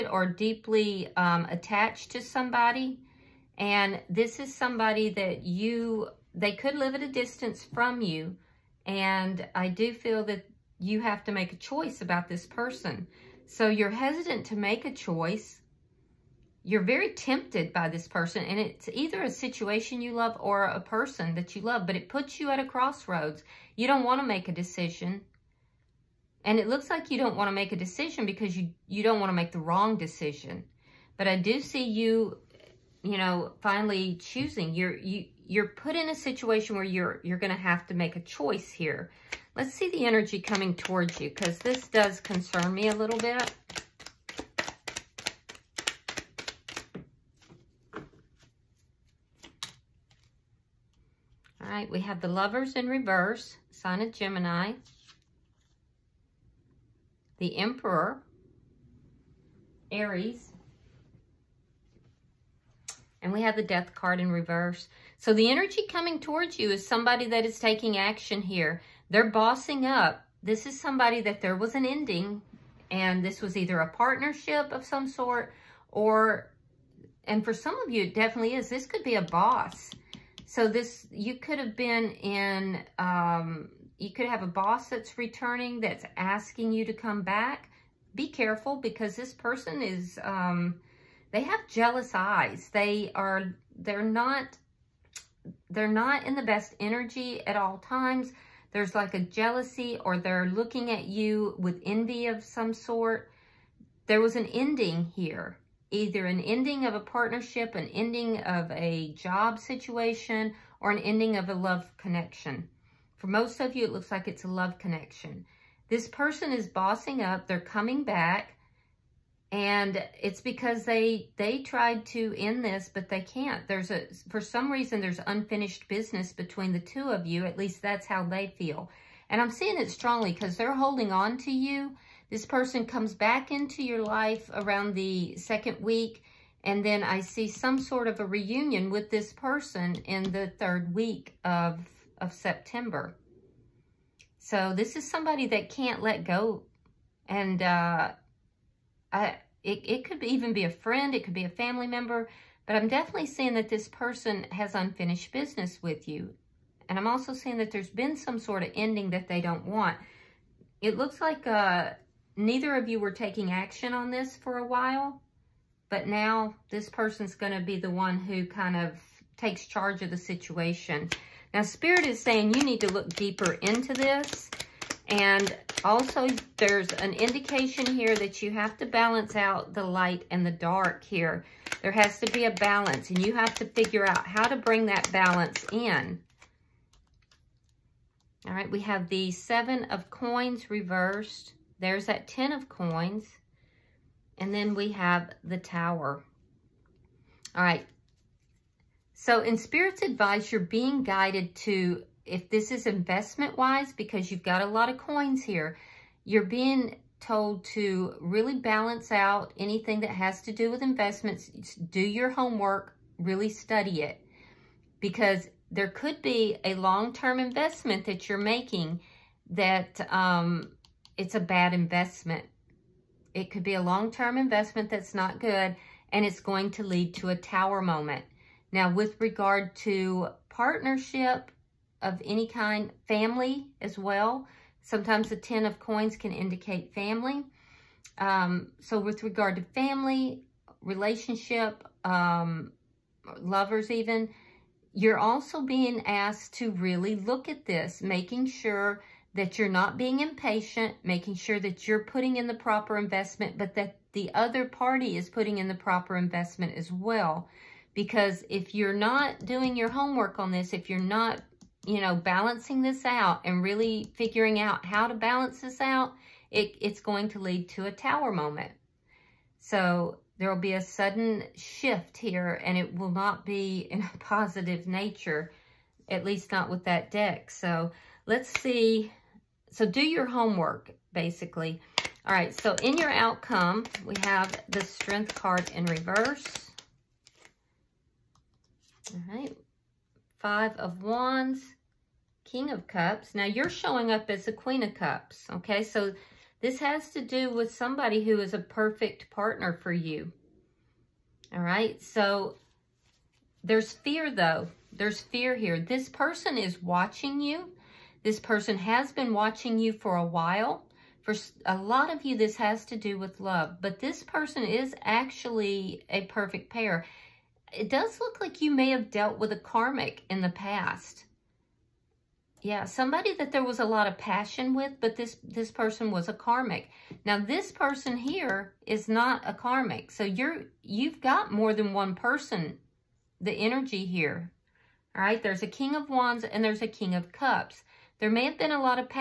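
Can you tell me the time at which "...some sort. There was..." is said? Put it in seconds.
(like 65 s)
102 s.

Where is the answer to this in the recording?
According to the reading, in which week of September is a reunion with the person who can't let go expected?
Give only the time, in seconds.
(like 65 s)
140 s.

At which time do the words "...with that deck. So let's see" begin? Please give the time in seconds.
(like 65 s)
276 s.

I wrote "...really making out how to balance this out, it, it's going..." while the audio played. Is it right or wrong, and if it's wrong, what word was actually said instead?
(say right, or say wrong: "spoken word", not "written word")
wrong: "figuring", not "making".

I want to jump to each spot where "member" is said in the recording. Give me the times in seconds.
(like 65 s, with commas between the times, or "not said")
151 s.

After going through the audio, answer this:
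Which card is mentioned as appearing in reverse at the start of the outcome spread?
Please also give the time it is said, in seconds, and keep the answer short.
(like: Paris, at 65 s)
Strength, at 284 s.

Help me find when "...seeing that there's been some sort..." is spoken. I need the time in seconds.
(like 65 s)
157 s.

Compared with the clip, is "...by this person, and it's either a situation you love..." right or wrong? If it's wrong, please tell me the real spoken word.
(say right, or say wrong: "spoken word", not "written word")
right.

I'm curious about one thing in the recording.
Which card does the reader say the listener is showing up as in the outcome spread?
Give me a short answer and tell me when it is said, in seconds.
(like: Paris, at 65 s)
Queen of Cups, at 294 s.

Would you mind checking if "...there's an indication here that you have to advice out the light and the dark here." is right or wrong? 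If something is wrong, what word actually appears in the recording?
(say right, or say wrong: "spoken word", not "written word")
wrong: "balance", not "advice".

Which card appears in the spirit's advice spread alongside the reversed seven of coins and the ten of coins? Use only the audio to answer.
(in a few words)
The Tower.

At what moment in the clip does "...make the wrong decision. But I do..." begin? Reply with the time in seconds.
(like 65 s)
29 s.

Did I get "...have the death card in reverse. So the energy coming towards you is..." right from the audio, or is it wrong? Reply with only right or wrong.
right.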